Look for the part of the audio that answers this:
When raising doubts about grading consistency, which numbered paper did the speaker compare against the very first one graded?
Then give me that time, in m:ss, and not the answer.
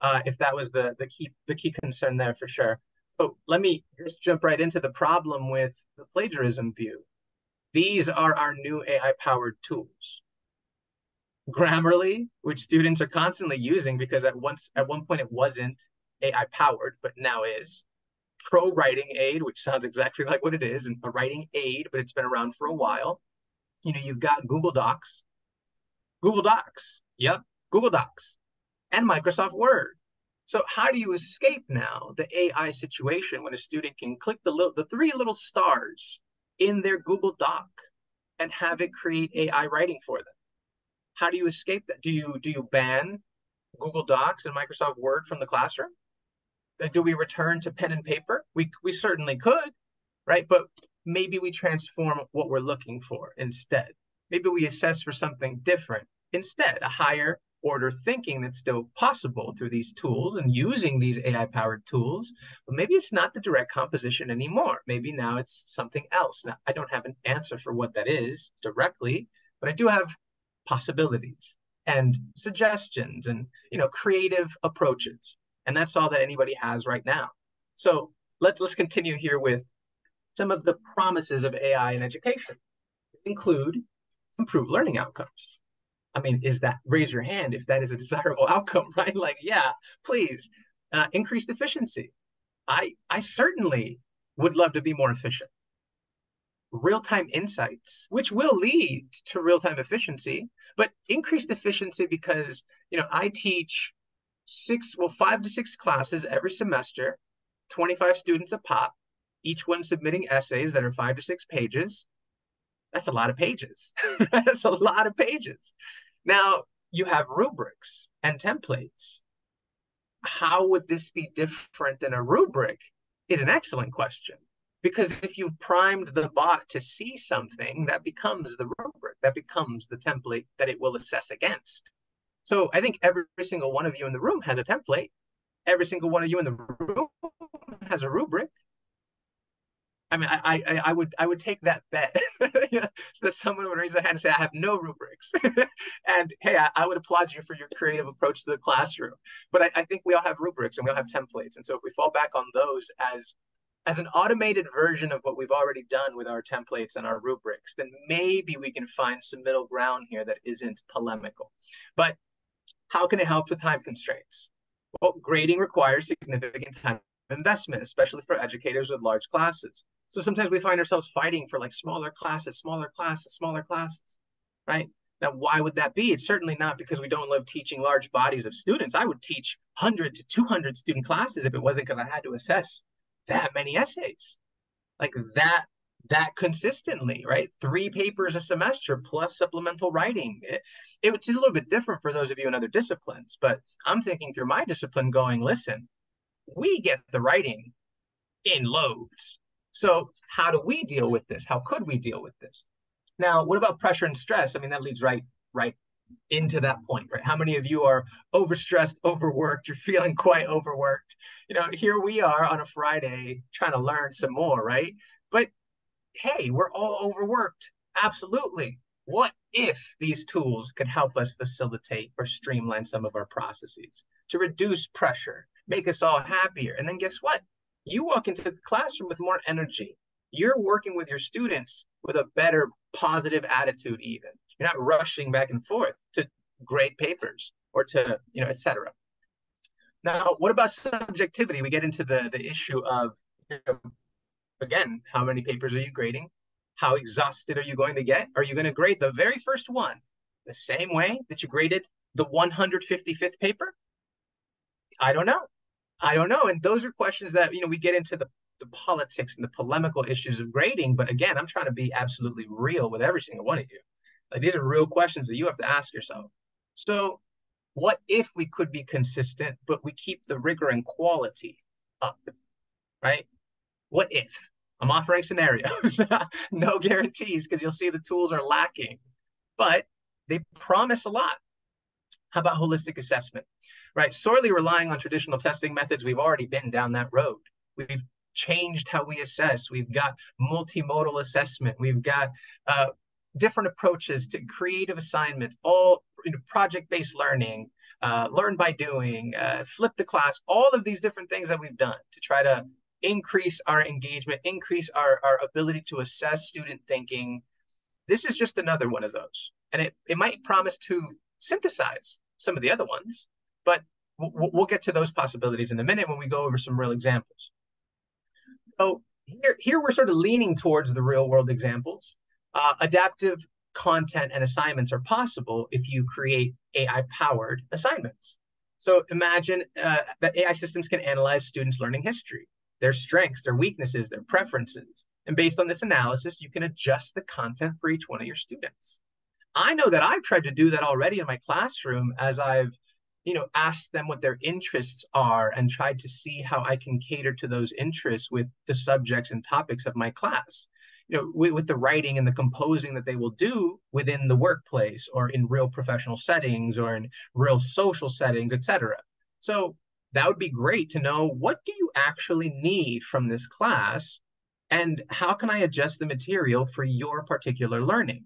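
4:12.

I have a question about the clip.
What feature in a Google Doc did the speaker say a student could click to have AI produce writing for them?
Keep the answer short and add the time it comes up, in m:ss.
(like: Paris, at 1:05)
three little stars, at 0:34.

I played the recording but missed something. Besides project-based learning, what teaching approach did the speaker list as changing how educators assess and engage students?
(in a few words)
flip the class.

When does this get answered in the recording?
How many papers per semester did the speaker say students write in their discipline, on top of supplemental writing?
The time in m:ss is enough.
3:07.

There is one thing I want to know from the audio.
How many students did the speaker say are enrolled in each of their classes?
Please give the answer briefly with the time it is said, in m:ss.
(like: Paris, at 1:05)
25, at 1:47.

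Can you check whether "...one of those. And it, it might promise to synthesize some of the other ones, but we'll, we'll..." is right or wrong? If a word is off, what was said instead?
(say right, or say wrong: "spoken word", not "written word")
right.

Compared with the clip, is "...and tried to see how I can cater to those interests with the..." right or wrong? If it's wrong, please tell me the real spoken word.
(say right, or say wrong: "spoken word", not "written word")
right.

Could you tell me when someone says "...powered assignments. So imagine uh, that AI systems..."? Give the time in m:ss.
5:27.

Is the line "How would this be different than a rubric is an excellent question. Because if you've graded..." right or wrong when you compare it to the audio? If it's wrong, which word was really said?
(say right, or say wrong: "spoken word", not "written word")
wrong: "primed", not "graded".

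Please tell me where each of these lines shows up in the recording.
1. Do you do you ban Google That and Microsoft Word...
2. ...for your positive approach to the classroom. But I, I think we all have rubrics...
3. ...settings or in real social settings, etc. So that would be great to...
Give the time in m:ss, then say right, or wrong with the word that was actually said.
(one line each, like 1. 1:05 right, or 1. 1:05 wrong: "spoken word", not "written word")
1. 0:42 wrong: "Docs", not "That"
2. 2:27 wrong: "creative", not "positive"
3. 5:56 right.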